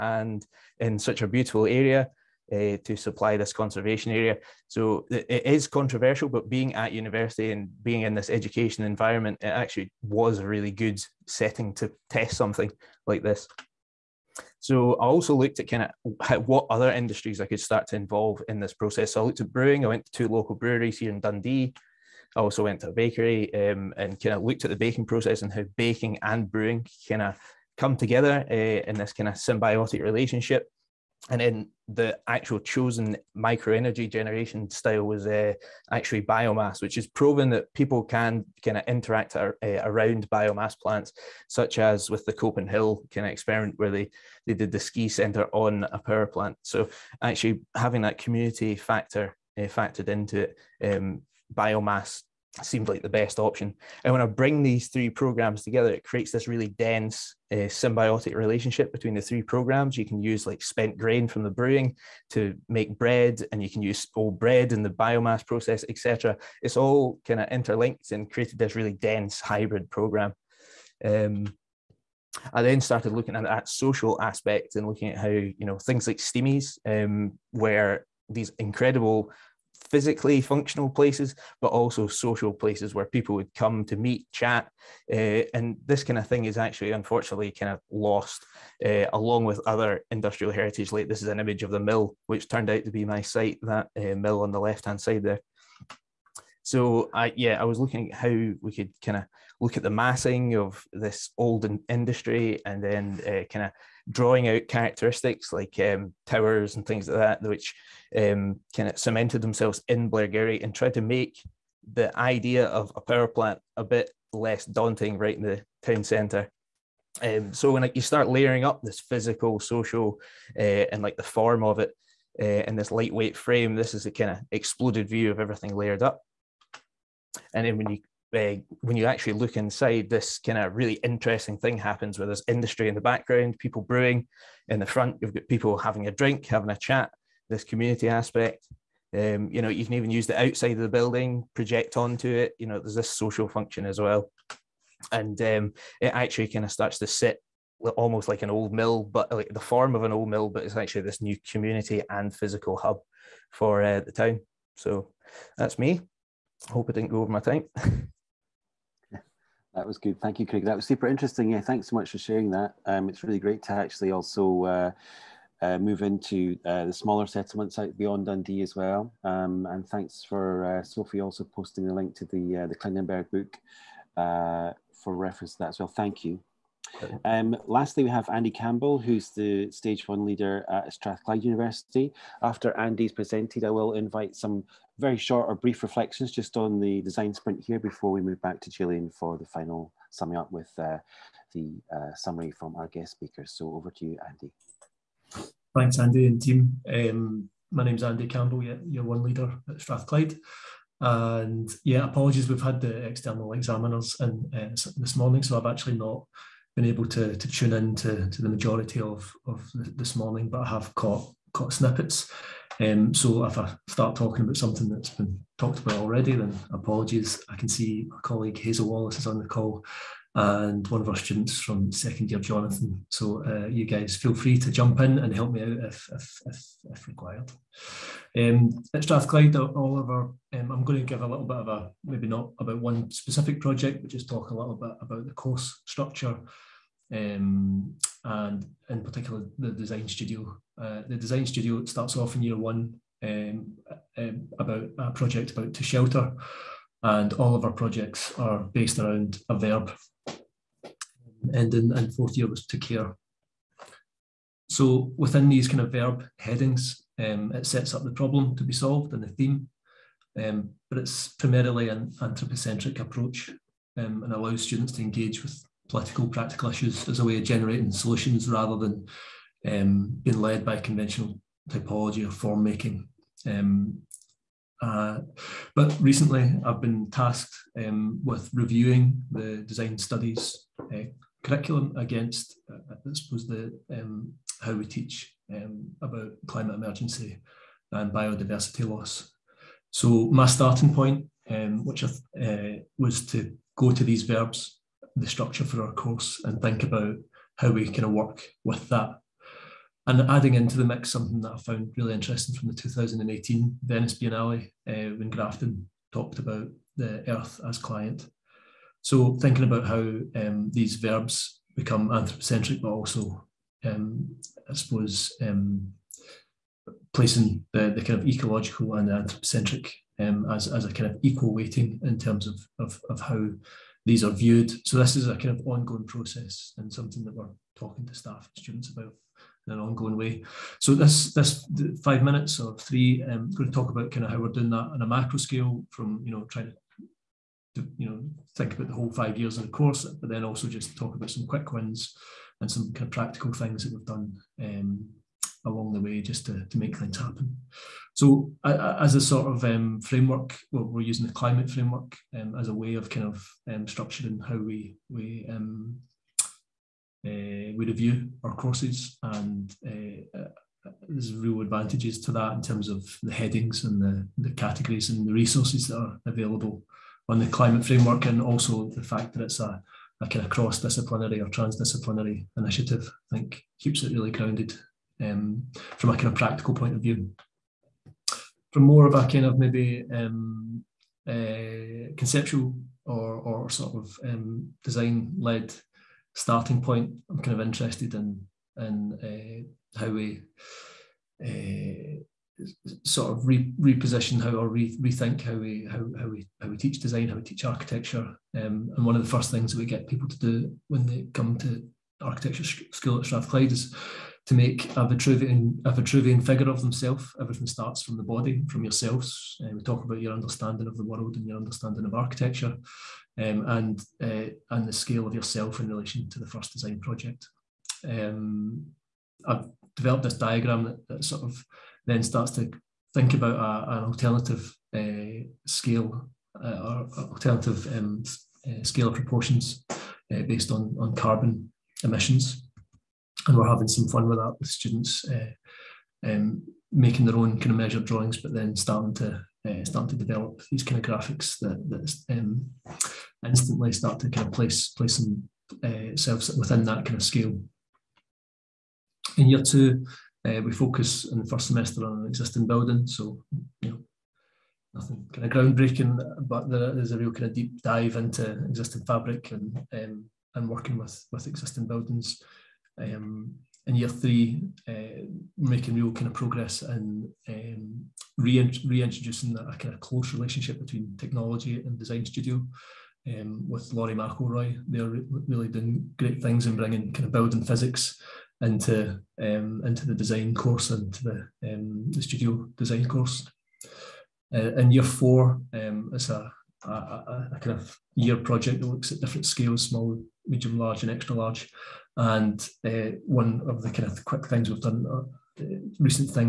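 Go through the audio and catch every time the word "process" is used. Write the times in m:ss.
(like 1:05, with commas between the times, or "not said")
0:18, 0:25, 1:05, 5:26.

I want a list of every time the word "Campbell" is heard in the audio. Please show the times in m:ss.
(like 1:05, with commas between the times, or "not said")
2:58, 3:18.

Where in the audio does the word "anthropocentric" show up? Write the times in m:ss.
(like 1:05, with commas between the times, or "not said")
4:22, 5:12, 5:19.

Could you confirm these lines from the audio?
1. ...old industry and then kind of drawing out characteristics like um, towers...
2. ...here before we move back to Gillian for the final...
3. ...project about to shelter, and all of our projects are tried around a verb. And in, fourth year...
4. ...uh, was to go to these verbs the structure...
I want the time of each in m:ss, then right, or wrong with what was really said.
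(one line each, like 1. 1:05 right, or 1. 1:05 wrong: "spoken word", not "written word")
1. 1:41 right
2. 3:07 right
3. 4:05 wrong: "based", not "tried"
4. 4:52 right.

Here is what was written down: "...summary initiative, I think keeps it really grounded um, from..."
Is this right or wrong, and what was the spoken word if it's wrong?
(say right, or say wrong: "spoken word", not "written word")
wrong: "transdisciplinary", not "summary".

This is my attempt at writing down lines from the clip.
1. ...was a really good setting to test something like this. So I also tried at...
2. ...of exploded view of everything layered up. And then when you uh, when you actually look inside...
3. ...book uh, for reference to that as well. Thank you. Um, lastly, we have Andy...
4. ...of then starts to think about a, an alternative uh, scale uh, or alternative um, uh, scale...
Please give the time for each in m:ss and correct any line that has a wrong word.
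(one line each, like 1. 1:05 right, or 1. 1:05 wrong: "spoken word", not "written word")
1. 0:10 wrong: "looked", not "tried"
2. 2:04 right
3. 2:53 right
4. 7:01 right.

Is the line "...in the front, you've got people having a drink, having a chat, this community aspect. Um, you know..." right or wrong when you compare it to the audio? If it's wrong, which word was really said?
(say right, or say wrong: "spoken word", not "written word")
right.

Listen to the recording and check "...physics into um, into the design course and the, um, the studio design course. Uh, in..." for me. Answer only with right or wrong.
right.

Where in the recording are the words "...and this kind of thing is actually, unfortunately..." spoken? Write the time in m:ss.
1:25.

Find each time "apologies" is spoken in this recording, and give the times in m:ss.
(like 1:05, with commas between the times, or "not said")
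3:22, 3:36.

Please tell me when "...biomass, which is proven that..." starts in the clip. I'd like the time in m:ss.
0:36.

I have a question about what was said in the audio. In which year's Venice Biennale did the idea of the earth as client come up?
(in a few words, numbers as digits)
2018.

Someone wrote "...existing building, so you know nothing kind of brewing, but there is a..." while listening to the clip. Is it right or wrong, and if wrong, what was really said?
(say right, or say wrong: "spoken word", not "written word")
wrong: "groundbreaking", not "brewing".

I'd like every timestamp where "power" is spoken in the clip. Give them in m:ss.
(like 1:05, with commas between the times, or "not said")
0:45, 1:52.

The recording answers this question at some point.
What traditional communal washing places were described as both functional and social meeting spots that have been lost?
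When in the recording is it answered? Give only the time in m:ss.
1:16.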